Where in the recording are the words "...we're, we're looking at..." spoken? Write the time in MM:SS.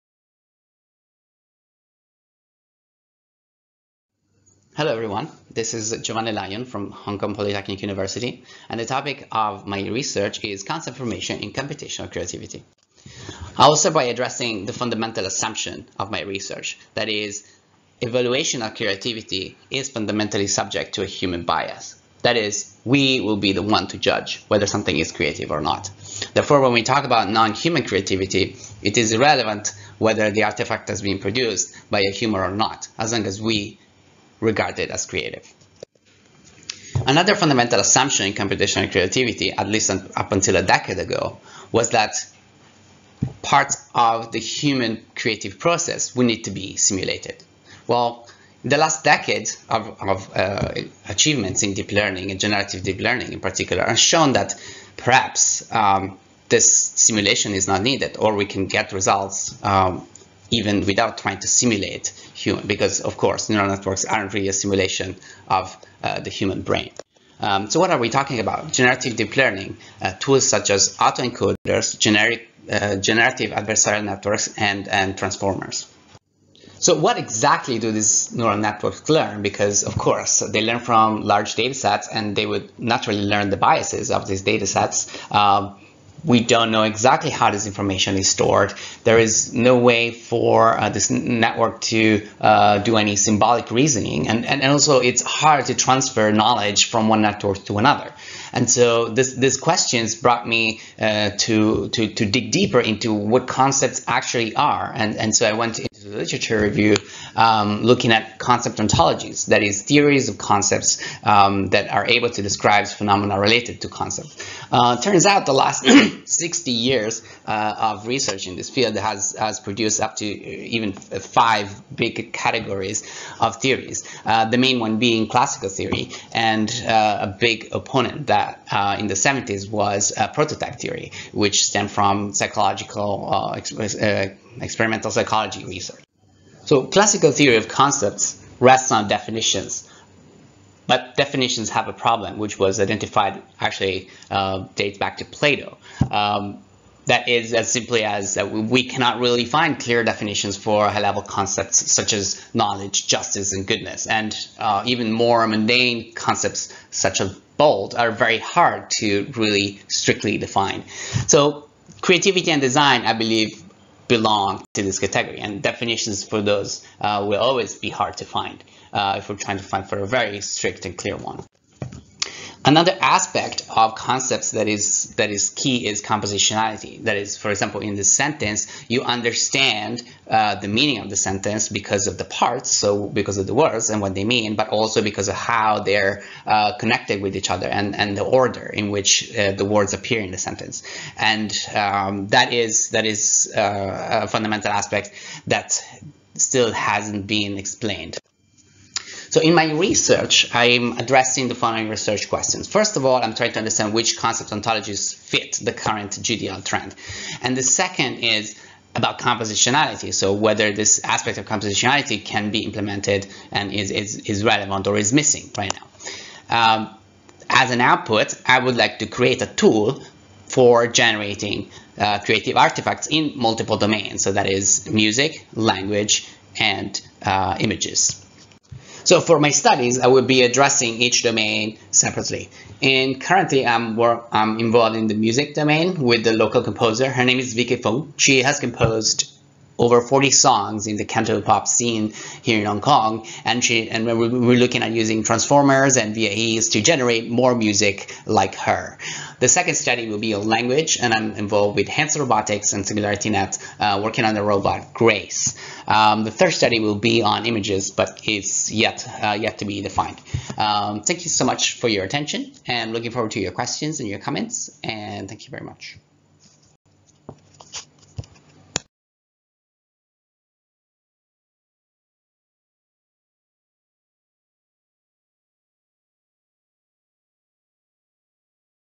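04:04.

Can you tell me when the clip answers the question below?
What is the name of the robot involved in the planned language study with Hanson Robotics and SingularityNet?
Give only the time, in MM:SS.
04:14.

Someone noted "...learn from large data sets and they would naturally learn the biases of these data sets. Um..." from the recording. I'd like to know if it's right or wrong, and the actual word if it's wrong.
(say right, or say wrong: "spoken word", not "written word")
right.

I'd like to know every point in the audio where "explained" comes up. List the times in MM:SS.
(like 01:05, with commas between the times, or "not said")
03:17.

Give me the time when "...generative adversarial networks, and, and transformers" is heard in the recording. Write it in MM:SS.
01:12.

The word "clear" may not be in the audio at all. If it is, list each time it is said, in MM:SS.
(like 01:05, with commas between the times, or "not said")
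02:29, 02:50.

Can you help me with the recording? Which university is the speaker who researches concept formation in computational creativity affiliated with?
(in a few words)
Hong Kong Polytechnic University.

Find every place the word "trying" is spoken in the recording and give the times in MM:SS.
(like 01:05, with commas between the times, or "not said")
01:01, 02:49, 03:23.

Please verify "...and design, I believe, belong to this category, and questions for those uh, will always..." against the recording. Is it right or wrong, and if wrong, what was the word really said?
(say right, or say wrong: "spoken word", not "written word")
wrong: "definitions", not "questions".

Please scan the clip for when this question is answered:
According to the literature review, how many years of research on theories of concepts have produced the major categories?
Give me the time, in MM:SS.
01:56.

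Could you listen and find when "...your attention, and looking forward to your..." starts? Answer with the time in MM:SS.
04:21.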